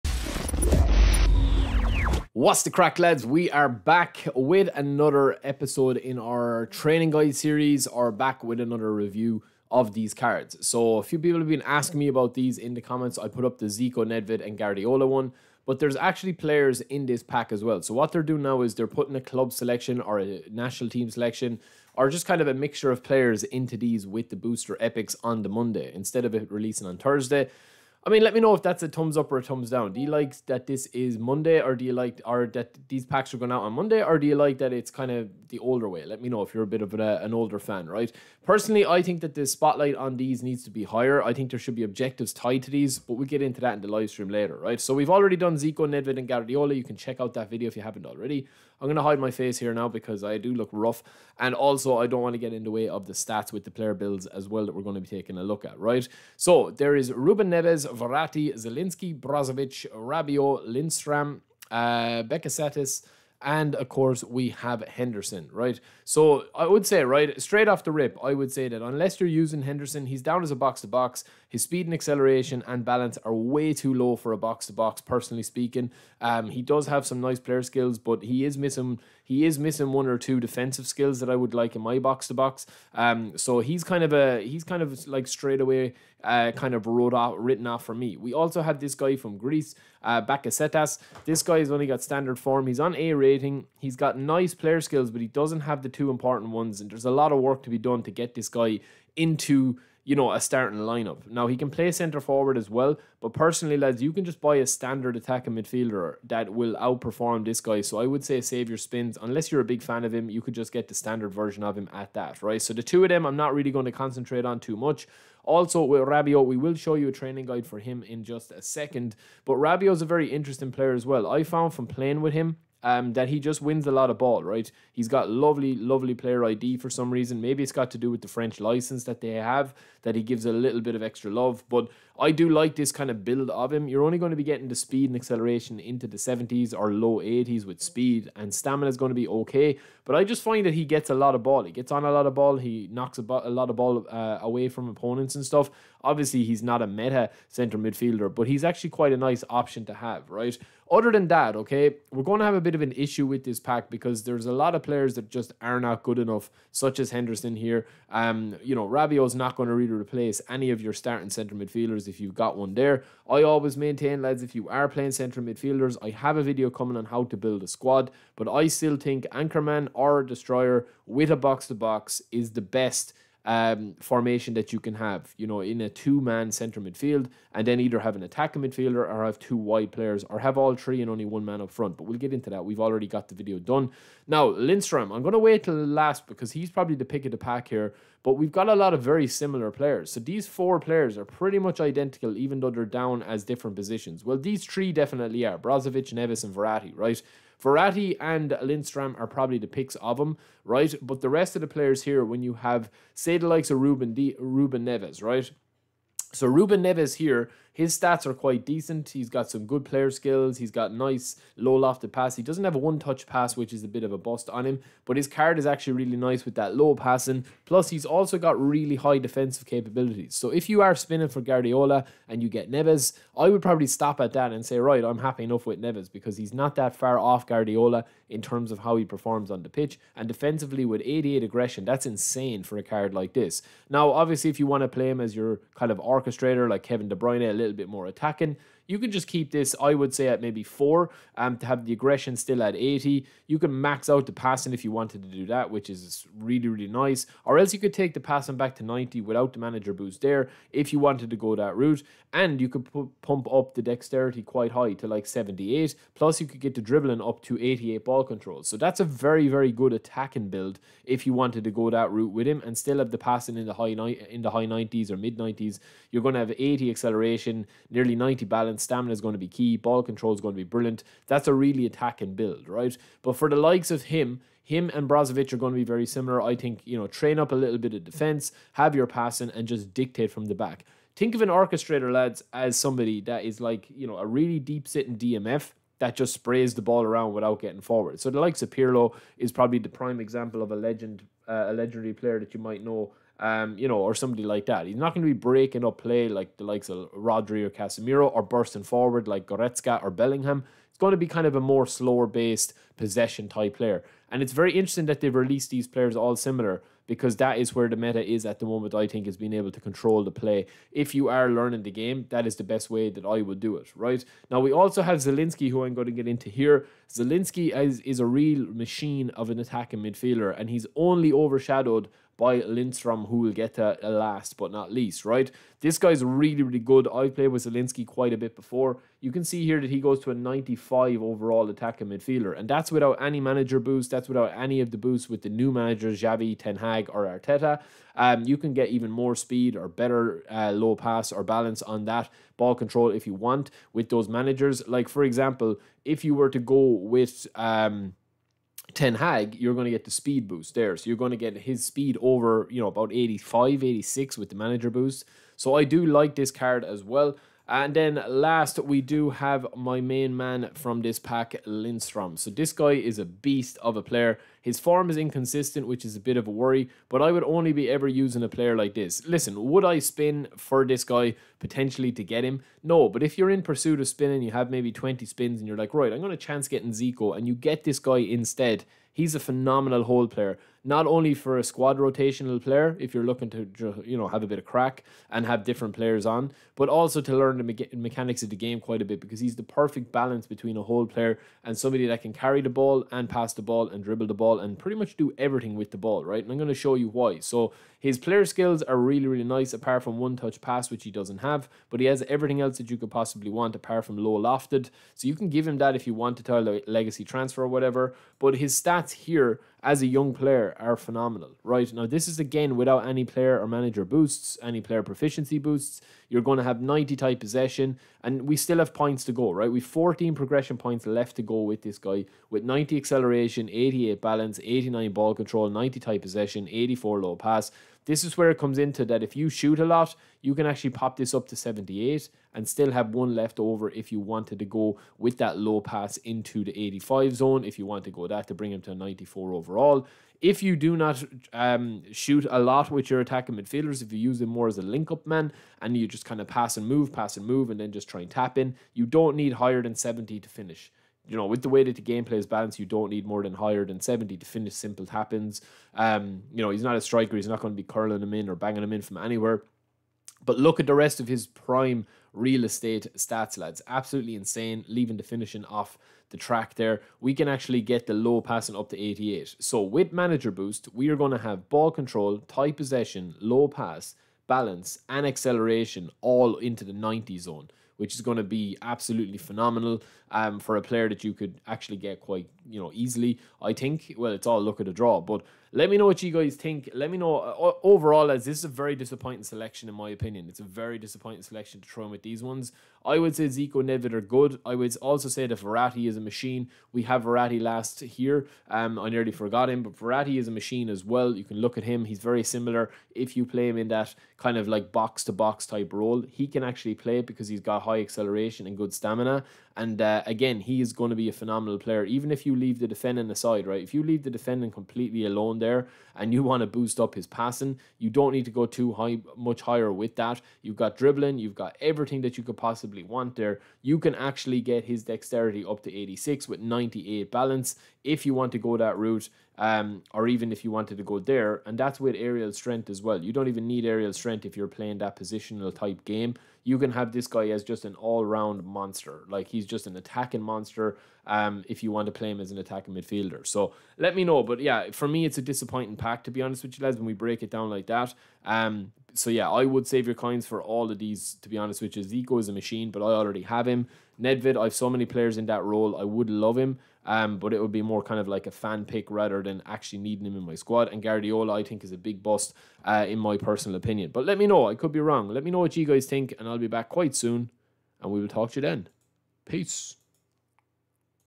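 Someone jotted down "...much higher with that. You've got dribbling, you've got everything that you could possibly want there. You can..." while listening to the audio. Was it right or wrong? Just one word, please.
right.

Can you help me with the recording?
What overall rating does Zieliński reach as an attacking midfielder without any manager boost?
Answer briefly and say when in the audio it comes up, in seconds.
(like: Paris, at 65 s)
95, at 330 s.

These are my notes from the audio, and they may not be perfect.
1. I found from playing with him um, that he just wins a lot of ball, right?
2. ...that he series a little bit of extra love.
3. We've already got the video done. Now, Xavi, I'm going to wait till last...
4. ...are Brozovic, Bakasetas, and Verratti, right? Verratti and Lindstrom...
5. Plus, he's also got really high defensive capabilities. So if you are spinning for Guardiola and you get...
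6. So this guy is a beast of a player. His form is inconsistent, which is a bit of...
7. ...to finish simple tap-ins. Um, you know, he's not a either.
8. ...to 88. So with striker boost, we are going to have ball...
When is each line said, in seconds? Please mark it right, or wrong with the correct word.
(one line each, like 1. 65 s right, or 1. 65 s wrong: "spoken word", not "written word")
1. 121 s right
2. 130 s wrong: "gives", not "series"
3. 182 s wrong: "Lindstrom", not "Xavi"
4. 195 s wrong: "Neves", not "Bakasetas"
5. 217 s right
6. 362 s right
7. 454 s wrong: "striker", not "either"
8. 468 s wrong: "manager", not "striker".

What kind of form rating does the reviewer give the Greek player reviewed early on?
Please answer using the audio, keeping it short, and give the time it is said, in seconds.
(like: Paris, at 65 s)
standard form, at 92 s.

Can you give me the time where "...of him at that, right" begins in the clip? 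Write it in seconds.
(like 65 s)
111 s.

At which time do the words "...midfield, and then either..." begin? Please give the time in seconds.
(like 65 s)
176 s.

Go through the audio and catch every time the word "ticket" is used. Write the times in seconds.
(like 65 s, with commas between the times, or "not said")
not said.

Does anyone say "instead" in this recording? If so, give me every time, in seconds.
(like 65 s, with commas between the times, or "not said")
25 s, 378 s.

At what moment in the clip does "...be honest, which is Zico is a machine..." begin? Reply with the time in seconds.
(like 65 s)
551 s.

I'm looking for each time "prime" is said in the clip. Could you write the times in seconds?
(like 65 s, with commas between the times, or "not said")
289 s, 461 s.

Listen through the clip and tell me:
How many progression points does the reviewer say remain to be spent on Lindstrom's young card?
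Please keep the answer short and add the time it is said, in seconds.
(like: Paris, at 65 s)
14, at 419 s.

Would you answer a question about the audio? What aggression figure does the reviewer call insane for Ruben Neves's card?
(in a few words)
88.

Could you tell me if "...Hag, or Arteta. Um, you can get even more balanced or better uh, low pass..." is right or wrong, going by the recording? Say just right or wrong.
wrong.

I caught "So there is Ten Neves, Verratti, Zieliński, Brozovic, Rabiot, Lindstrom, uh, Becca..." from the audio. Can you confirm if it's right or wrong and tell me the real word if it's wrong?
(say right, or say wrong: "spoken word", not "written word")
wrong: "Ruben", not "Ten".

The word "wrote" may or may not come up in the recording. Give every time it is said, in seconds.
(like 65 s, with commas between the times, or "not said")
86 s.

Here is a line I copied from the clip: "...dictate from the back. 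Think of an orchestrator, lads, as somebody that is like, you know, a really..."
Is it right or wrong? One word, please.
right.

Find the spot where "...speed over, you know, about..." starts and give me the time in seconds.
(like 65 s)
351 s.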